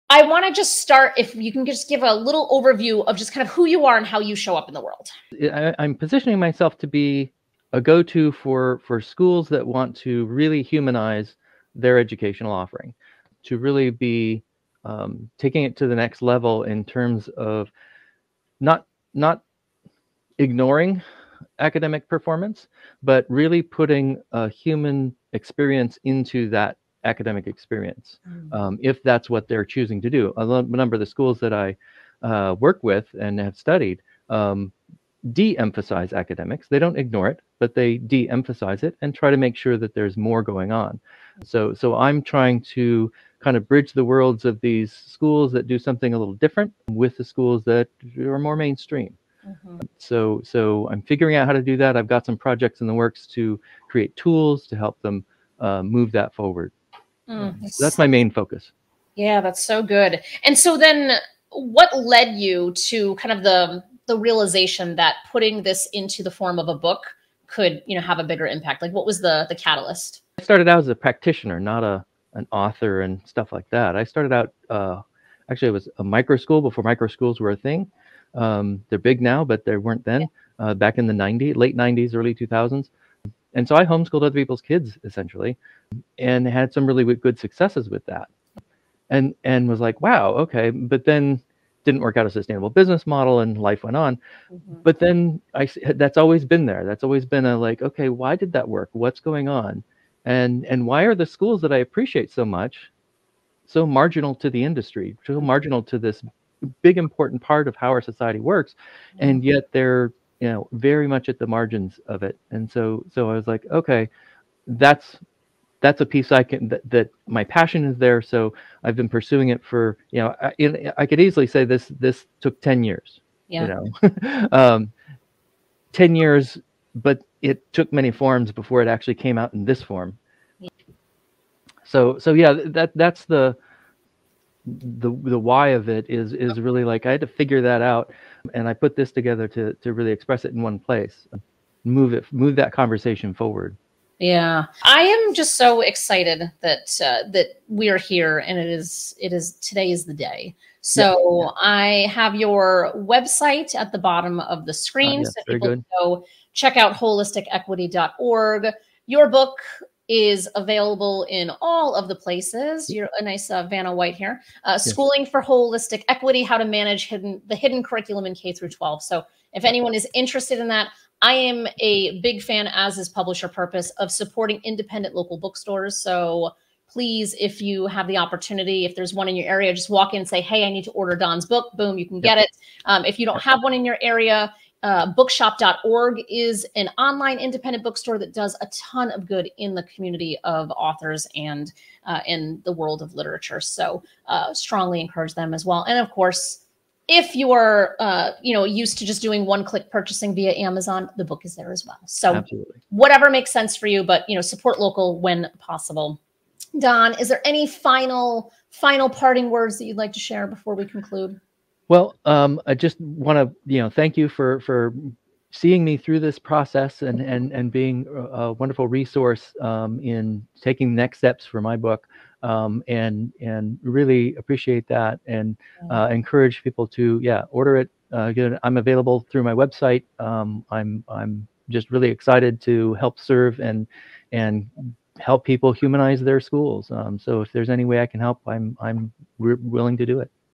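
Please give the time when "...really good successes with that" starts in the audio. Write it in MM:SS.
01:26.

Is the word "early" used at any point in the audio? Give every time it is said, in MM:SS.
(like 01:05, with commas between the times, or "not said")
01:22.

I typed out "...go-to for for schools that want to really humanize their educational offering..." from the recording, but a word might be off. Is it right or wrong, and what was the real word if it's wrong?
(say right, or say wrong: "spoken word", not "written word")
right.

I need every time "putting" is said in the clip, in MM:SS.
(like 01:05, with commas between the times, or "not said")
00:23, 01:05.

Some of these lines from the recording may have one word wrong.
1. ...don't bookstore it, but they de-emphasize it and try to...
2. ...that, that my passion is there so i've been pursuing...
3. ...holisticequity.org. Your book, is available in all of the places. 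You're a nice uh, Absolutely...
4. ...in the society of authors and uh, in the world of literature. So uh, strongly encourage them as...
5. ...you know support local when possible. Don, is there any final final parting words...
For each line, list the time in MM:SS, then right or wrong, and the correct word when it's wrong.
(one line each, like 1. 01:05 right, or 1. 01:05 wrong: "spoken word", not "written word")
1. 00:36 wrong: "ignore", not "bookstore"
2. 01:56 right
3. 02:36 wrong: "Vanna", not "Absolutely"
4. 03:09 wrong: "community", not "society"
5. 03:24 right.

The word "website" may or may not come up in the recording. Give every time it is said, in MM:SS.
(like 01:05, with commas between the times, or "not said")
02:32, 03:49.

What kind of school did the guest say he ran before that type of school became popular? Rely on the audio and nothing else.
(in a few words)
micro school.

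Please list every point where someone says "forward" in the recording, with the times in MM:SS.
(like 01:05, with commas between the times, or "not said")
00:56, 02:23.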